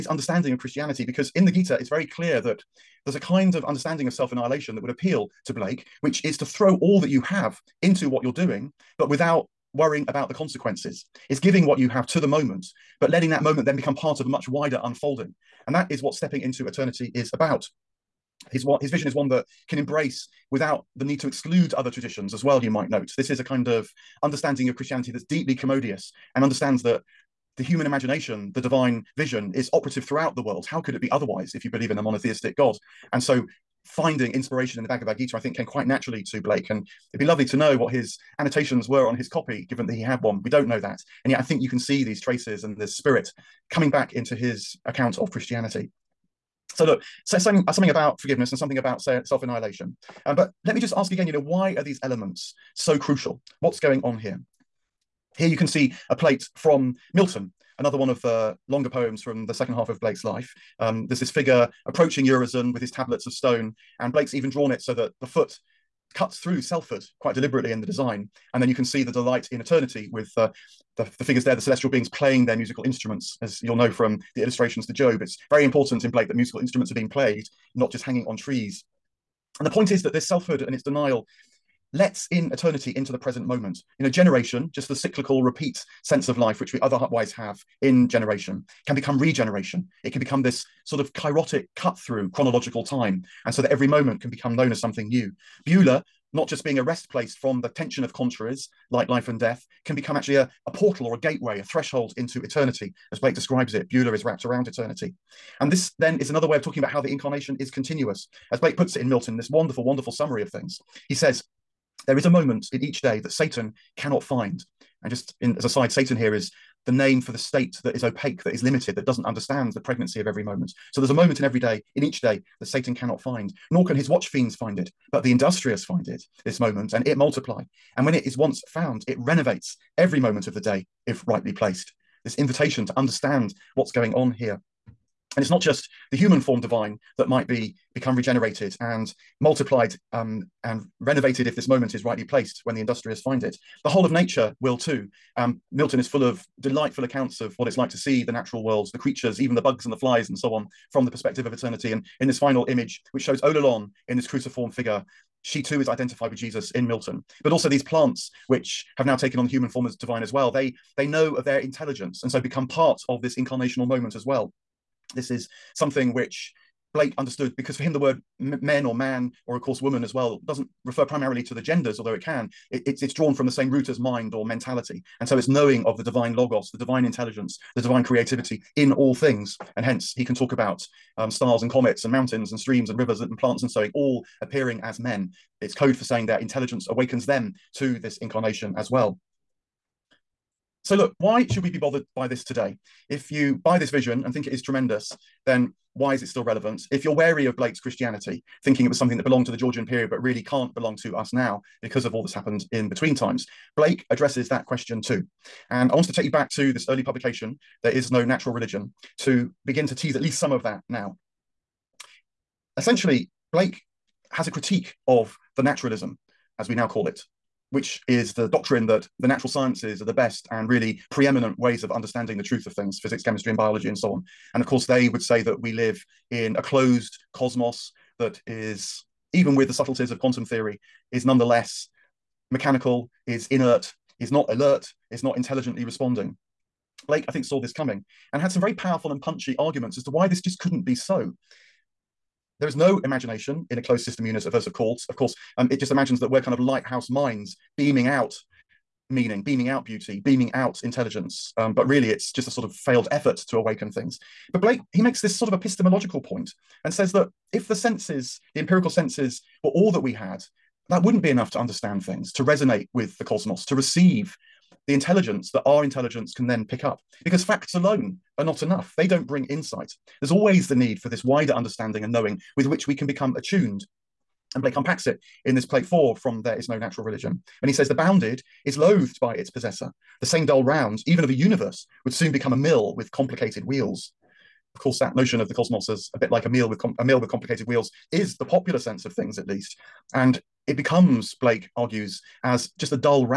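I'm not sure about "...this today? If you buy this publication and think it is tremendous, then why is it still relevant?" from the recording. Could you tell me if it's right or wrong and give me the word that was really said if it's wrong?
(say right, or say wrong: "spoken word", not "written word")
wrong: "vision", not "publication".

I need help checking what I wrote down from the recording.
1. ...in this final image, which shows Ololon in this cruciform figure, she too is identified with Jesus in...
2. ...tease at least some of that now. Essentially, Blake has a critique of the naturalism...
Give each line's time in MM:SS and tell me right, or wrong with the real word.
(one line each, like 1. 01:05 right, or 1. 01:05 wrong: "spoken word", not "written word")
1. 02:32 right
2. 03:29 right.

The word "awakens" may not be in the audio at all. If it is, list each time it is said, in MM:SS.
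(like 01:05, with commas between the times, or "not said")
03:06, 04:13.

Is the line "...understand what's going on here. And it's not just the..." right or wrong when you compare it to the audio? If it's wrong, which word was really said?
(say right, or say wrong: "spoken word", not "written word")
right.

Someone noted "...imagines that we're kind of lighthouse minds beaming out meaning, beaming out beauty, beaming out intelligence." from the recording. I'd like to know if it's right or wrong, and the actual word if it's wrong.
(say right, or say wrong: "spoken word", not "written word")
right.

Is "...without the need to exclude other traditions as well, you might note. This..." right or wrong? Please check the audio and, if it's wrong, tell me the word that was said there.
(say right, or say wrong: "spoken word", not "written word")
right.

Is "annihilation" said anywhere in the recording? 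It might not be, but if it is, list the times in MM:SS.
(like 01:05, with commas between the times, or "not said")
00:04, 00:48.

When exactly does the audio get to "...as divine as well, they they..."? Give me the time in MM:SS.
02:39.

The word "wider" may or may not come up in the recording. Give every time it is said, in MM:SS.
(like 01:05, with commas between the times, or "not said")
00:14, 04:31.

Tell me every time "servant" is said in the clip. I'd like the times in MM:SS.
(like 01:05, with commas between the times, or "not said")
not said.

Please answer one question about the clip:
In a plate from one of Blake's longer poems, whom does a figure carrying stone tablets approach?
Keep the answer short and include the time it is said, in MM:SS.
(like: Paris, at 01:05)
Urizen, at 01:02.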